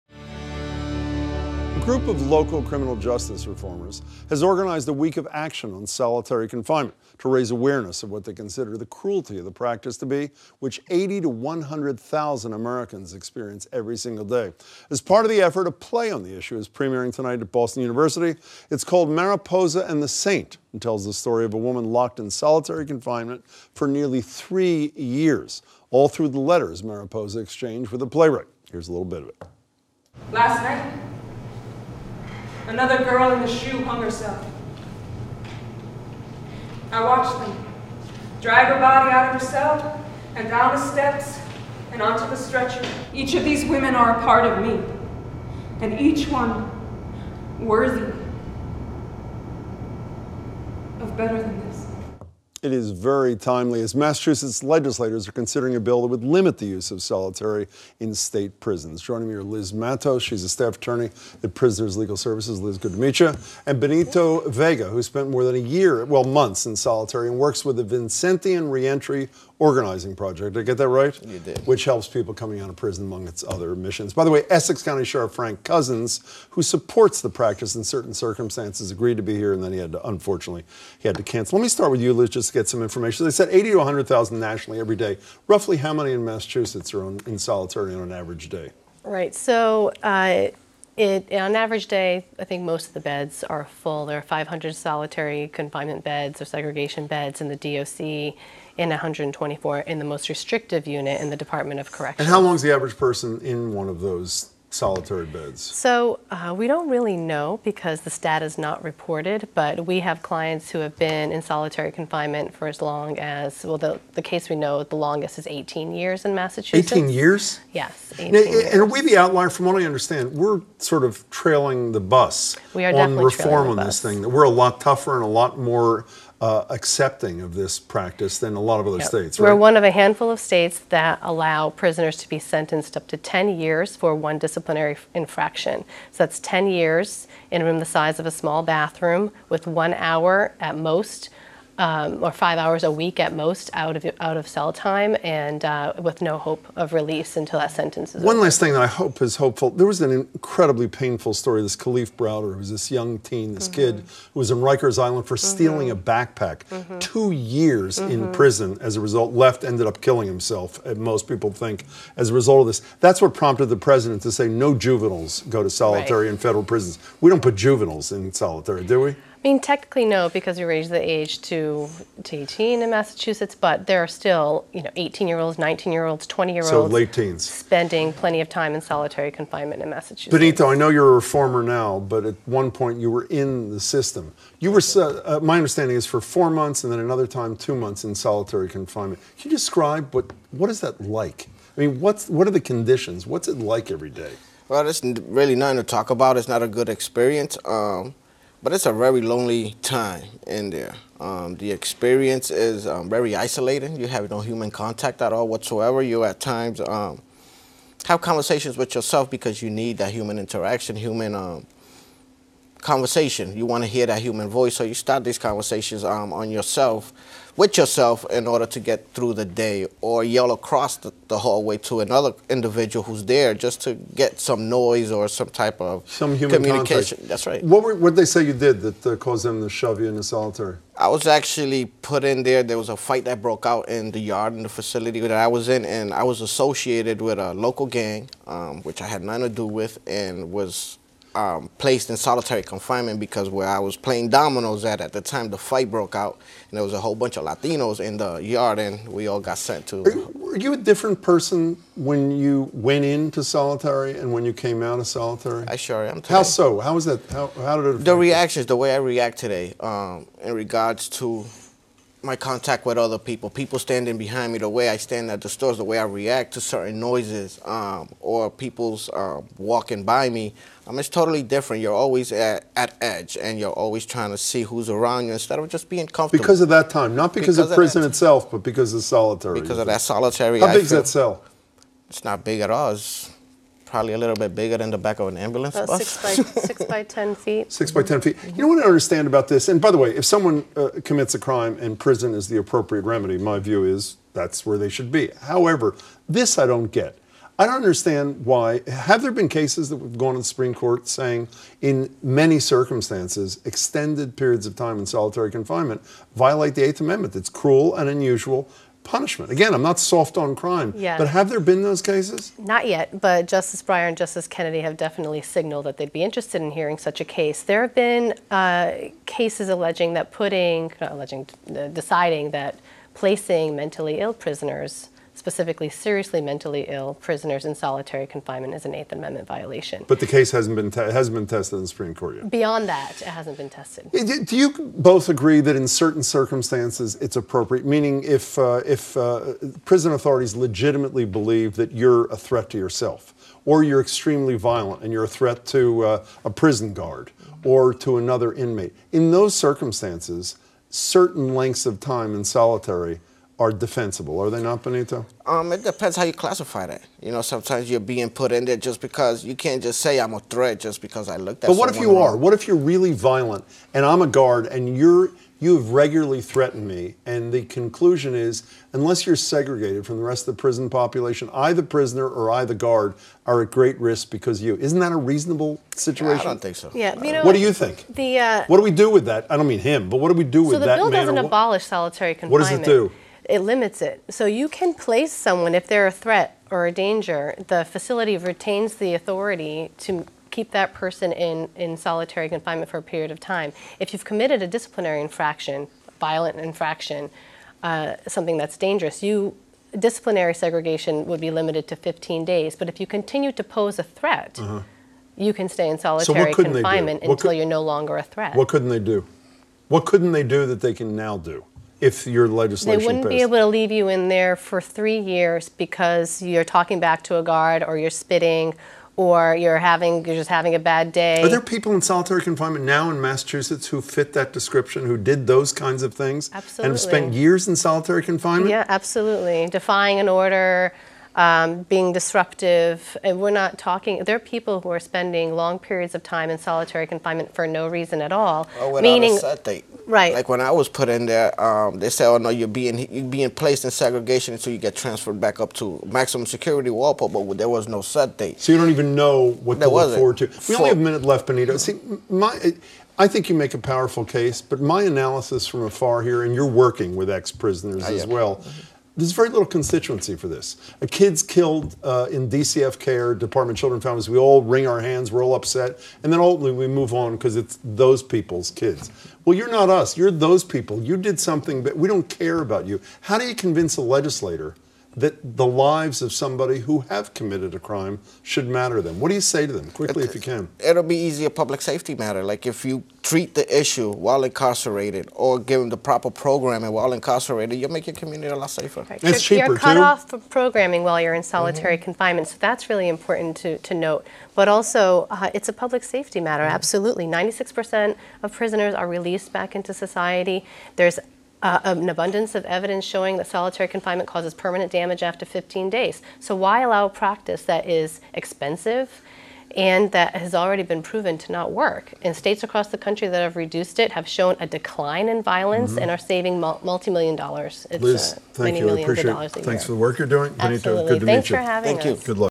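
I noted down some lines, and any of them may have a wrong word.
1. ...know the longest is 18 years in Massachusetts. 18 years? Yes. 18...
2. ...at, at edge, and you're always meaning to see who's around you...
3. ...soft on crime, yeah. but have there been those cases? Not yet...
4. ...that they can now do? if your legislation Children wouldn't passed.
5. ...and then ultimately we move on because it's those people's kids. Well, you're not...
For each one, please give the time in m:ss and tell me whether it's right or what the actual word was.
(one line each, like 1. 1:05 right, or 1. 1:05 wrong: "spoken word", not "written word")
1. 1:54 right
2. 4:32 wrong: "trying", not "meaning"
3. 5:09 right
4. 6:50 wrong: "They", not "Children"
5. 7:46 right.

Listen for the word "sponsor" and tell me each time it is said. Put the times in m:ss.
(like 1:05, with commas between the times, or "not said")
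not said.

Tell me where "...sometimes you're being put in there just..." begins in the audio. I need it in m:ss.
5:57.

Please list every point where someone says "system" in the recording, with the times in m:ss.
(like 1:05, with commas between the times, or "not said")
3:03.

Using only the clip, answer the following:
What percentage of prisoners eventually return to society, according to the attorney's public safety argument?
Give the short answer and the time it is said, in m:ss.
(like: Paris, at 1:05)
96%, at 8:17.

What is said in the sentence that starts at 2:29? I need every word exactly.
There was an incredibly painful story.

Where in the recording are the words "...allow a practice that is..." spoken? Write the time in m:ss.
8:26.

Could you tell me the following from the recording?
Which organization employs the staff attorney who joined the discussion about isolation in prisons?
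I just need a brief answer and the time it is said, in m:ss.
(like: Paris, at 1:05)
Prisoners Legal Services, at 1:01.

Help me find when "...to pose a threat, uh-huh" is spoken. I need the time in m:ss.
6:43.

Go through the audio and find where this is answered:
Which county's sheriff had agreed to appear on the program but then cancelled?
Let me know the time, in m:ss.
1:14.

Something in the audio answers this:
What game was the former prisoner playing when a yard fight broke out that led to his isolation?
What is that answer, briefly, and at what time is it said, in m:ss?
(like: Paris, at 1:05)
dominoes, at 4:04.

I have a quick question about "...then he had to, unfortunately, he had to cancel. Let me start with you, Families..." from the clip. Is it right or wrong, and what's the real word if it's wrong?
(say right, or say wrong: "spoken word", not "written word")
wrong: "Liz", not "Families".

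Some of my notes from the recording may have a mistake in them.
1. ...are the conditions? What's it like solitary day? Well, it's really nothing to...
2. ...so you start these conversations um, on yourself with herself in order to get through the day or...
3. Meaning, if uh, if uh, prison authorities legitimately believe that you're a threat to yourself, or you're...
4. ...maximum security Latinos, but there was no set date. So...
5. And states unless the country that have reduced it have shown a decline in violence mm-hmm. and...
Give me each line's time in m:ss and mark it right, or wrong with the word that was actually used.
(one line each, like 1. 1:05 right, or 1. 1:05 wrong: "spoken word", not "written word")
1. 3:12 wrong: "every", not "solitary"
2. 3:34 wrong: "yourself", not "herself"
3. 5:37 right
4. 7:26 wrong: "Walpole", not "Latinos"
5. 8:32 wrong: "across", not "unless".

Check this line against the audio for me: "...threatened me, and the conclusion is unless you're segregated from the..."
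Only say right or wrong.
right.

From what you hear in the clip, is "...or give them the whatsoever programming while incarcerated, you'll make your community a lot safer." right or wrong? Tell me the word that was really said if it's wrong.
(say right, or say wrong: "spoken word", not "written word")
wrong: "proper", not "whatsoever".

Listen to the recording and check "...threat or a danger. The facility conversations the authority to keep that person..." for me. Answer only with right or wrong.
wrong.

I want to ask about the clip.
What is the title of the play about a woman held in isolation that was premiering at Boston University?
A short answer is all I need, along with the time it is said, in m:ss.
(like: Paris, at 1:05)
Mariposa and the Saint, at 0:19.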